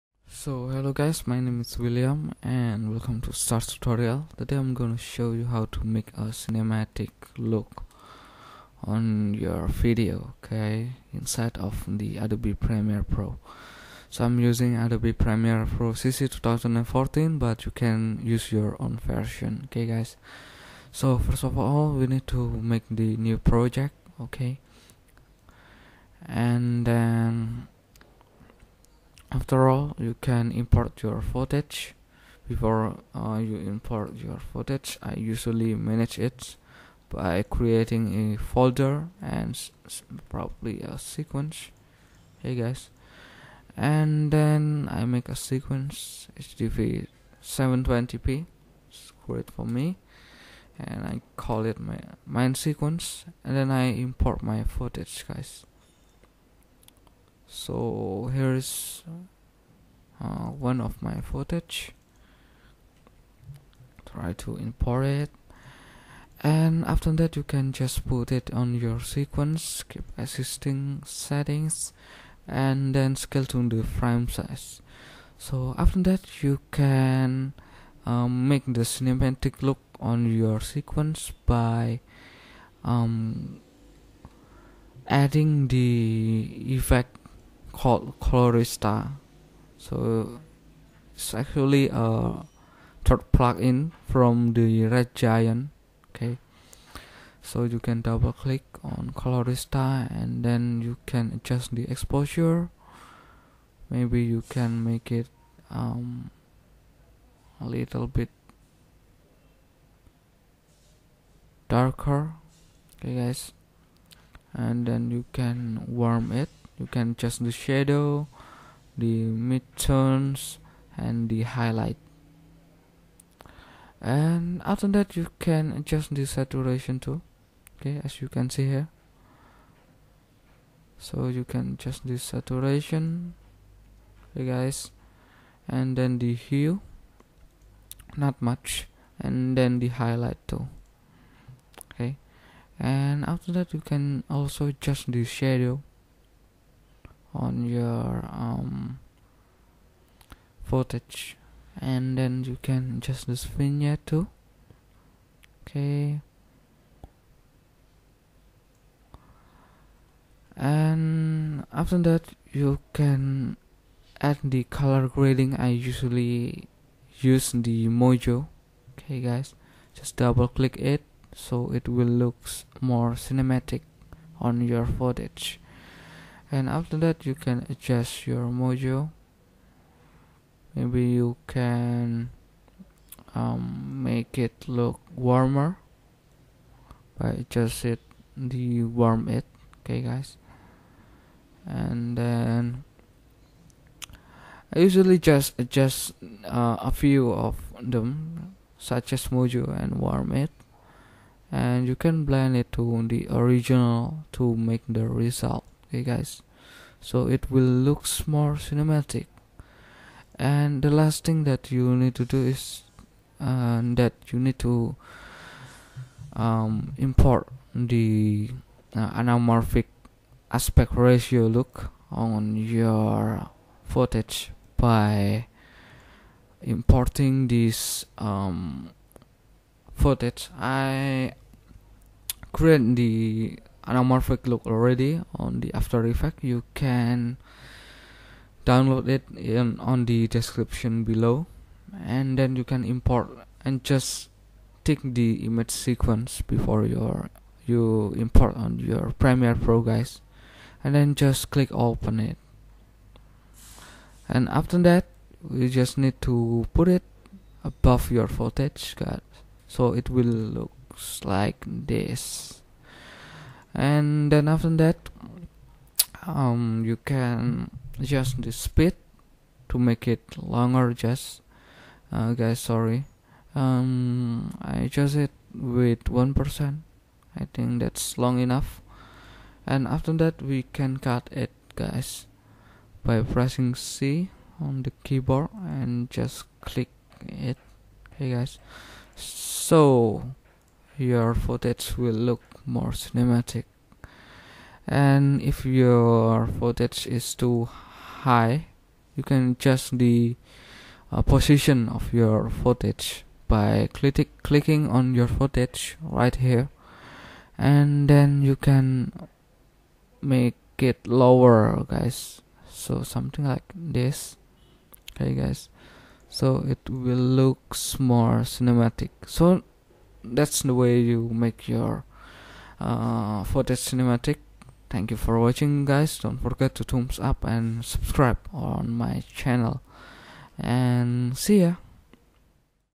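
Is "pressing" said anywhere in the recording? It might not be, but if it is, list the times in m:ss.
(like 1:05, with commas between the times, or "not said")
4:43.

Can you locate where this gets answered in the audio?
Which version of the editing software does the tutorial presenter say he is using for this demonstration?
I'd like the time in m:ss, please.
0:14.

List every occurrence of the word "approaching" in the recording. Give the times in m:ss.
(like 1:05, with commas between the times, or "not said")
not said.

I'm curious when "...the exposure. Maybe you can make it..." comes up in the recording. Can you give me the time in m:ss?
1:41.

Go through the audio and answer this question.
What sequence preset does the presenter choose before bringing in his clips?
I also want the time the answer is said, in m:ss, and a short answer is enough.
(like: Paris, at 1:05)
HDV 720p, at 0:46.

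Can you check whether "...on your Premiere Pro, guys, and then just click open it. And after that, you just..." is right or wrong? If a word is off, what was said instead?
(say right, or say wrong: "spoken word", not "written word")
right.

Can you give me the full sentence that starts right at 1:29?
So it's actually a third plugin from the Red Giant.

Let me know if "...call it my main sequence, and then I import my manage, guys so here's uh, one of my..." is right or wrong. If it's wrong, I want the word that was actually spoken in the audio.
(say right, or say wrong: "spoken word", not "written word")
wrong: "footage", not "manage".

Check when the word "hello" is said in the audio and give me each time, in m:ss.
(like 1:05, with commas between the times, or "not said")
0:00.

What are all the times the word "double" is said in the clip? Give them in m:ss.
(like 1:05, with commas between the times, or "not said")
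1:38, 2:50.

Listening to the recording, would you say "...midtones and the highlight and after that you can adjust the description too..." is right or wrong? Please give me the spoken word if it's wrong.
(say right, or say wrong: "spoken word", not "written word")
wrong: "saturation", not "description".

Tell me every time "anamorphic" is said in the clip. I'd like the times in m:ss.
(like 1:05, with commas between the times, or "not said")
3:39, 3:53.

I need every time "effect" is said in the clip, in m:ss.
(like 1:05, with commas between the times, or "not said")
1:26, 3:56.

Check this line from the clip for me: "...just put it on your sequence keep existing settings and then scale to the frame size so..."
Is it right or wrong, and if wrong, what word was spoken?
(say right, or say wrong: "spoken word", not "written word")
right.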